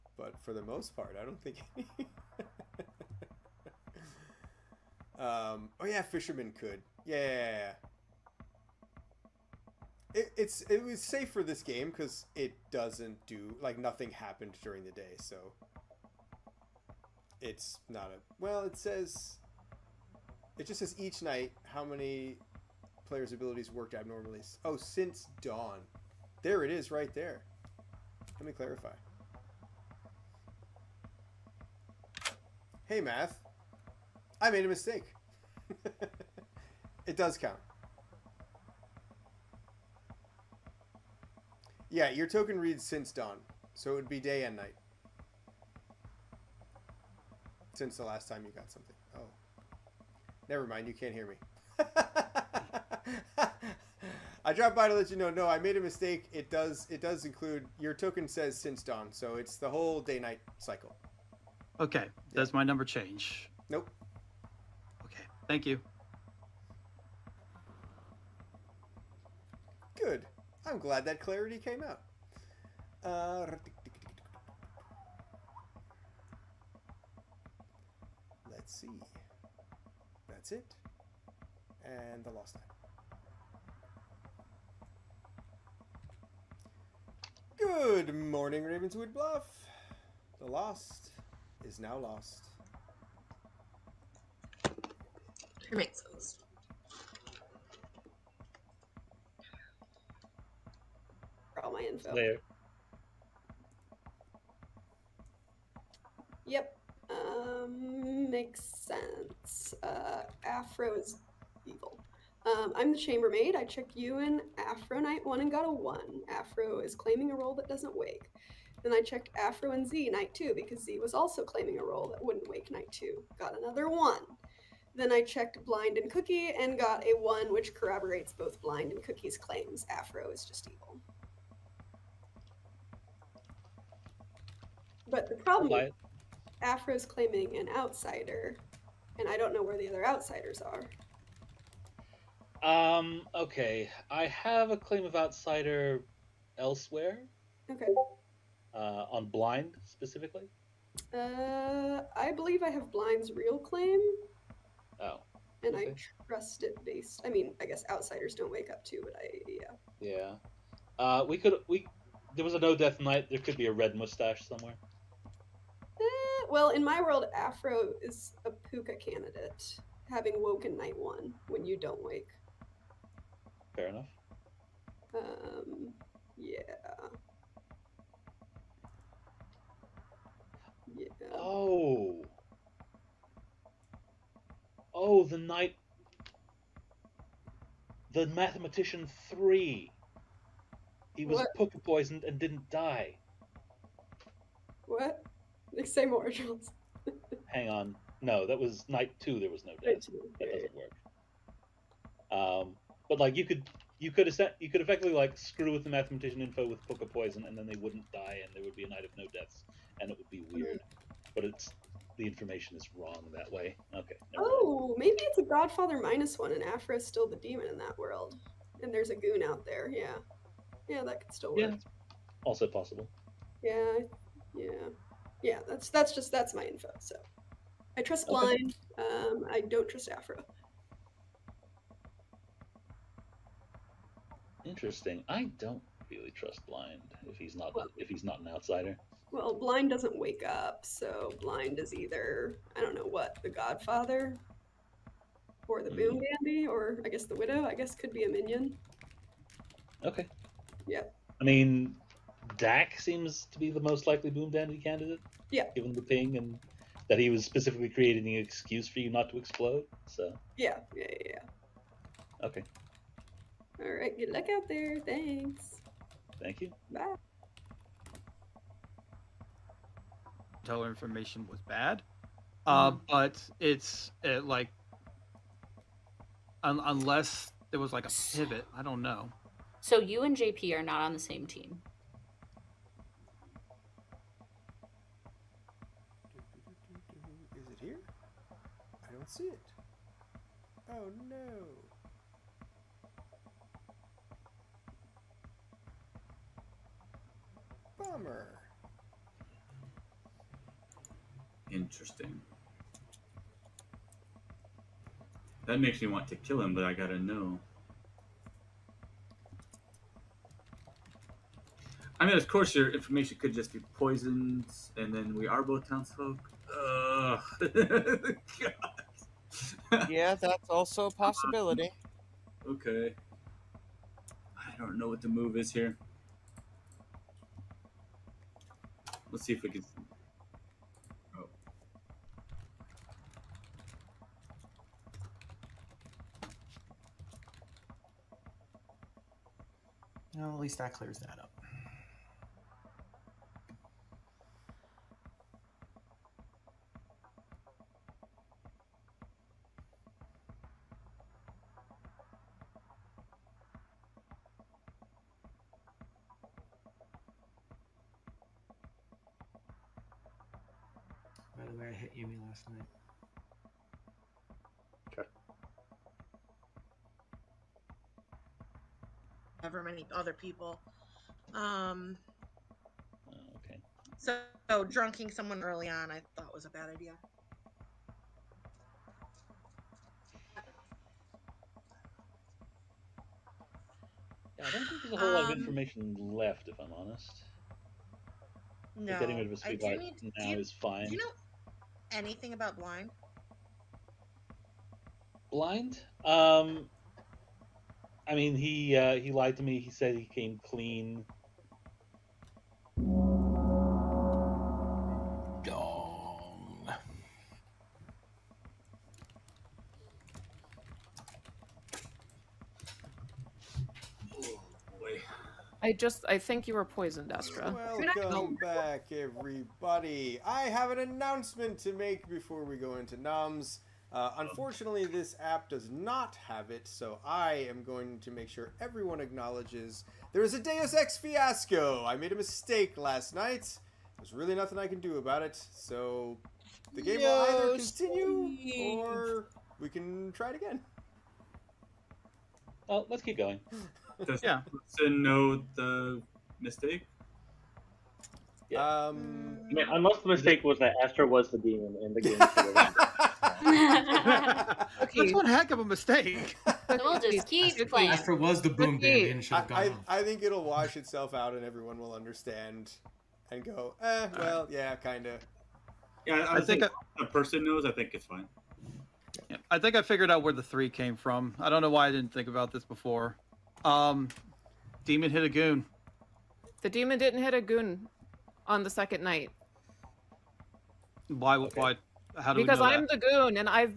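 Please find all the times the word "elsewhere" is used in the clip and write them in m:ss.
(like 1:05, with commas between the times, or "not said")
2:26.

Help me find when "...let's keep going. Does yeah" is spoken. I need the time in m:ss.
7:23.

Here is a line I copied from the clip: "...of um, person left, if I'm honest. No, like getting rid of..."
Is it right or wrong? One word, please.
wrong.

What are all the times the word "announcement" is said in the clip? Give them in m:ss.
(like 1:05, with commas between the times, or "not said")
7:00.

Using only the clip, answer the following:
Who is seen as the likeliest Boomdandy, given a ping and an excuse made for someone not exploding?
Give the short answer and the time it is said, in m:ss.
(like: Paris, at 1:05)
Dak, at 4:12.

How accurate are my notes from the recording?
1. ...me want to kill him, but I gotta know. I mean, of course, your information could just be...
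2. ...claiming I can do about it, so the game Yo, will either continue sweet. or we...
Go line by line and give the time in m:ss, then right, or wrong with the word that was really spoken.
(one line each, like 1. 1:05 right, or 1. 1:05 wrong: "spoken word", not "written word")
1. 5:05 right
2. 7:14 wrong: "nothing", not "claiming".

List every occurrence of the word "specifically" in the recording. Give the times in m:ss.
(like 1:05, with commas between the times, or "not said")
2:29, 4:17.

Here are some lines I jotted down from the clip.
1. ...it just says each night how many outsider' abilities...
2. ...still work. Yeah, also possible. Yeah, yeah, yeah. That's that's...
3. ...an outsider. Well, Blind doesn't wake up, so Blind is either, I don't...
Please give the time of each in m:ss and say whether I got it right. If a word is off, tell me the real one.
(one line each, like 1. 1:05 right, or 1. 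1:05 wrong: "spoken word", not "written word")
1. 0:20 wrong: "players", not "outsider"
2. 3:41 right
3. 3:58 right.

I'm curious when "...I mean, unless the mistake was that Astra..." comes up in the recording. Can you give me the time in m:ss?
7:29.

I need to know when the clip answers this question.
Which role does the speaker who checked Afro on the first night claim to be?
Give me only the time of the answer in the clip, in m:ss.
1:52.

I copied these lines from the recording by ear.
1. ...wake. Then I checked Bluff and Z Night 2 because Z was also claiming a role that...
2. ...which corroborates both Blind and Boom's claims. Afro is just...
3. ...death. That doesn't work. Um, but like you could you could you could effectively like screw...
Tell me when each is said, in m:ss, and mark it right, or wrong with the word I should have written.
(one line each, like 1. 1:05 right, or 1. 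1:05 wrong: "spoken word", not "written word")
1. 1:57 wrong: "Afro", not "Bluff"
2. 2:07 wrong: "Cookie", not "Boom"
3. 3:19 right.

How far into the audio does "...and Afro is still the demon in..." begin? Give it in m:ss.
3:36.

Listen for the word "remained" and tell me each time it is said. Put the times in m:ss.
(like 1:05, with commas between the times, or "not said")
not said.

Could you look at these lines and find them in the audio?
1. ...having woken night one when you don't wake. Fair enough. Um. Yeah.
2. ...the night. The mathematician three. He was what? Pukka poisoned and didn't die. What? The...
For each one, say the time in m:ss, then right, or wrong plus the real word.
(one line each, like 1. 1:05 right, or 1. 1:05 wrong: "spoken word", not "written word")
1. 2:50 right
2. 3:05 right.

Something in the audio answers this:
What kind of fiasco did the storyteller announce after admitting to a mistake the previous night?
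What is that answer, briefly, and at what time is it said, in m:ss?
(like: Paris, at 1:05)
Deus Ex fiasco, at 7:10.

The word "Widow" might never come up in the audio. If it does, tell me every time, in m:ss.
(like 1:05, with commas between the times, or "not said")
4:07.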